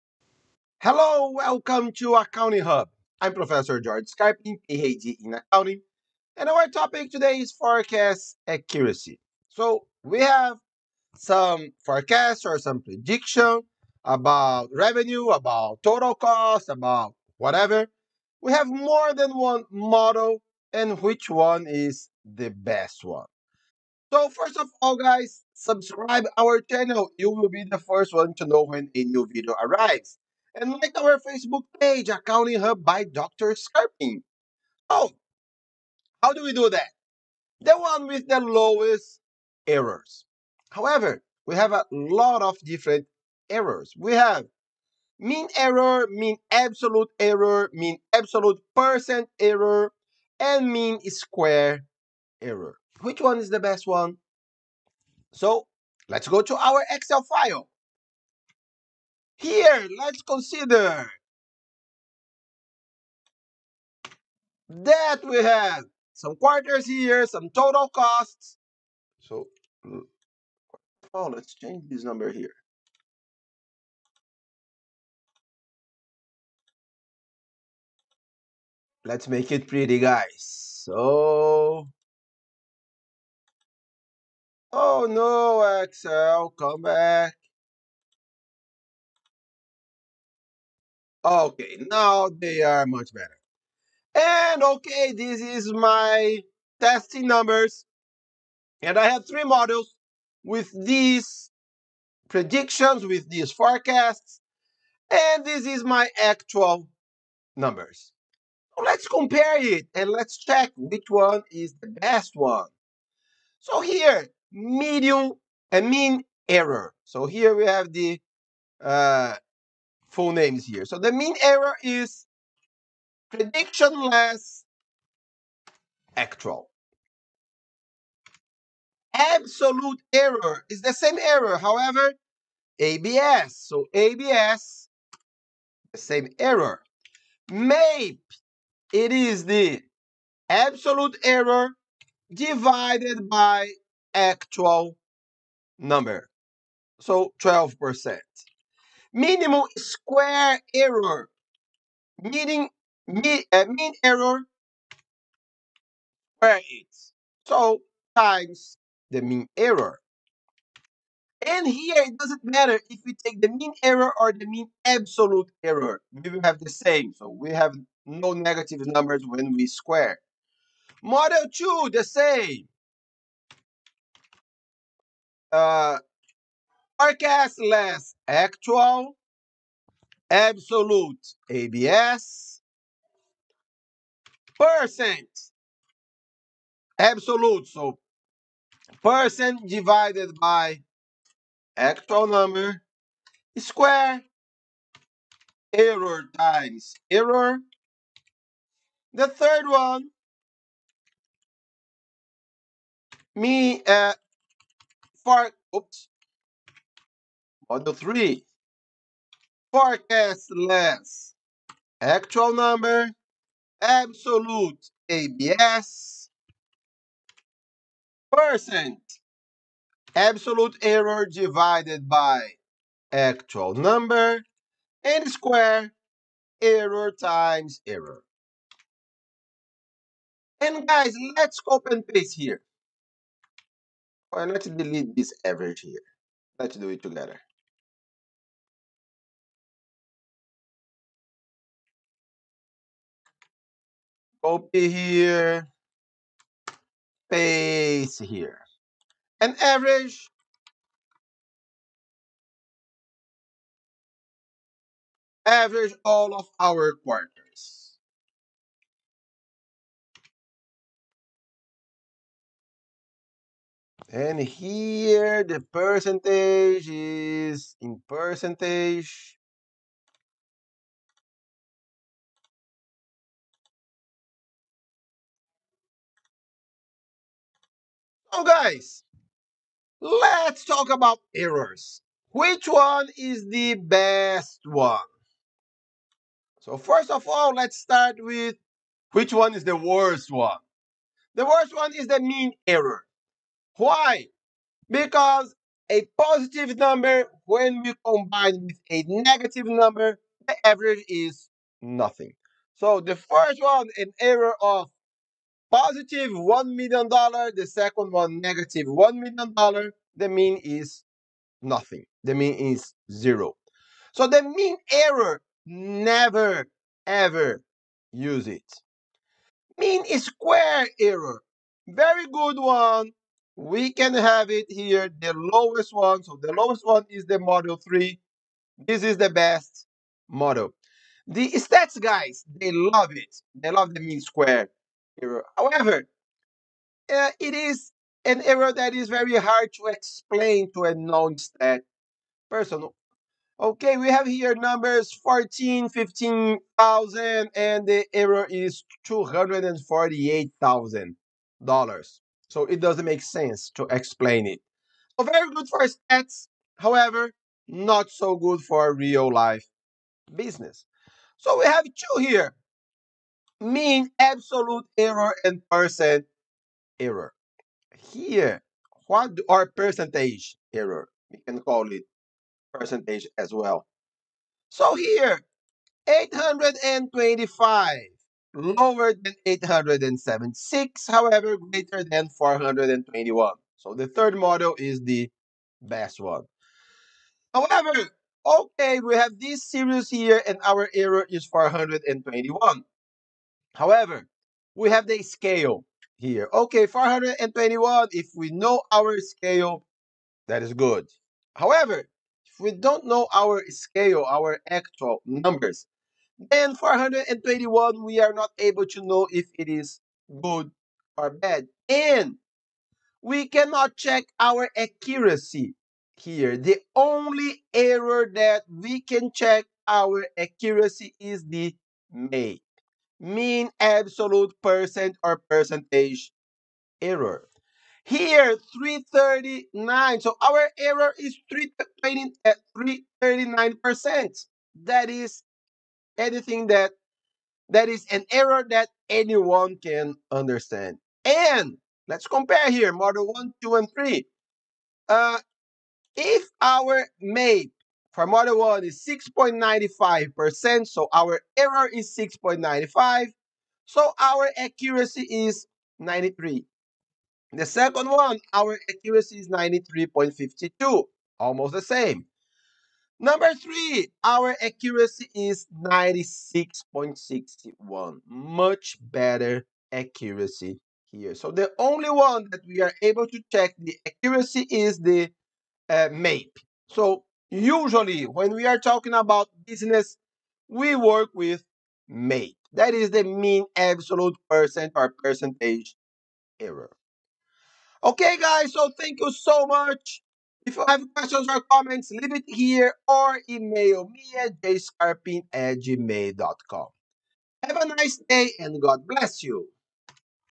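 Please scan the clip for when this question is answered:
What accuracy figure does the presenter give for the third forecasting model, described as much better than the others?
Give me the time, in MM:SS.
07:45.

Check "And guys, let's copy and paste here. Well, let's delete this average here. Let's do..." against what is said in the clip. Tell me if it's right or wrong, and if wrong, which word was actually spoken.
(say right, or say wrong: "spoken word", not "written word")
right.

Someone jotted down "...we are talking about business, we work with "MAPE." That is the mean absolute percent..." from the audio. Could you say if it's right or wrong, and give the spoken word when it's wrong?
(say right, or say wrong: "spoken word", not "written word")
right.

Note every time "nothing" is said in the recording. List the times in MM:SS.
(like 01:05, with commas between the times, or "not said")
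05:01, 05:11.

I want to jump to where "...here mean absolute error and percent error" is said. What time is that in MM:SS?
06:02.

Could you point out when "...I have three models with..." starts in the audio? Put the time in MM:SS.
01:38.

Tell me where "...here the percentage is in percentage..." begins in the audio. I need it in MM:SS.
04:24.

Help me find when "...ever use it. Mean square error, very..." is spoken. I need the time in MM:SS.
05:17.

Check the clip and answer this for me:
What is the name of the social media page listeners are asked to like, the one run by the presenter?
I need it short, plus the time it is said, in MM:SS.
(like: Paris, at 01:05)
Accounting Hub by Dr. Scarpin, at 00:32.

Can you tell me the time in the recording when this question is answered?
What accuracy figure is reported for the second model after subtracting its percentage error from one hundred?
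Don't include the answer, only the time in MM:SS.
07:39.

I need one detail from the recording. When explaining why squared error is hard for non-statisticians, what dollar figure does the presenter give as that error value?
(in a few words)
$248,000.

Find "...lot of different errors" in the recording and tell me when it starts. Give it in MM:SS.
00:41.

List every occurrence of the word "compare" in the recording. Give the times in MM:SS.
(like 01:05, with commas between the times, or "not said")
01:49, 07:22.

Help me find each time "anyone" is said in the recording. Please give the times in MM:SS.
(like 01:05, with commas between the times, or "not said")
07:19.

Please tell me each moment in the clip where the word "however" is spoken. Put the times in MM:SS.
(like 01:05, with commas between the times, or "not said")
00:40, 02:11, 05:35, 05:56, 06:21, 06:27, 06:33, 06:41.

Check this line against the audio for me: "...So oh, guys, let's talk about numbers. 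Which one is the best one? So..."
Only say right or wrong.
wrong.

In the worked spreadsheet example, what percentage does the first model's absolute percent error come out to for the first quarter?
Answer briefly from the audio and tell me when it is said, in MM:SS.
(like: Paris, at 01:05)
12%, at 02:27.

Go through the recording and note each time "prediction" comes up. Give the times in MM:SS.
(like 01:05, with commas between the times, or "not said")
00:12, 01:42, 02:03.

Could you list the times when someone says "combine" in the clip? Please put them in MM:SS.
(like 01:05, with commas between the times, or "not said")
04:58.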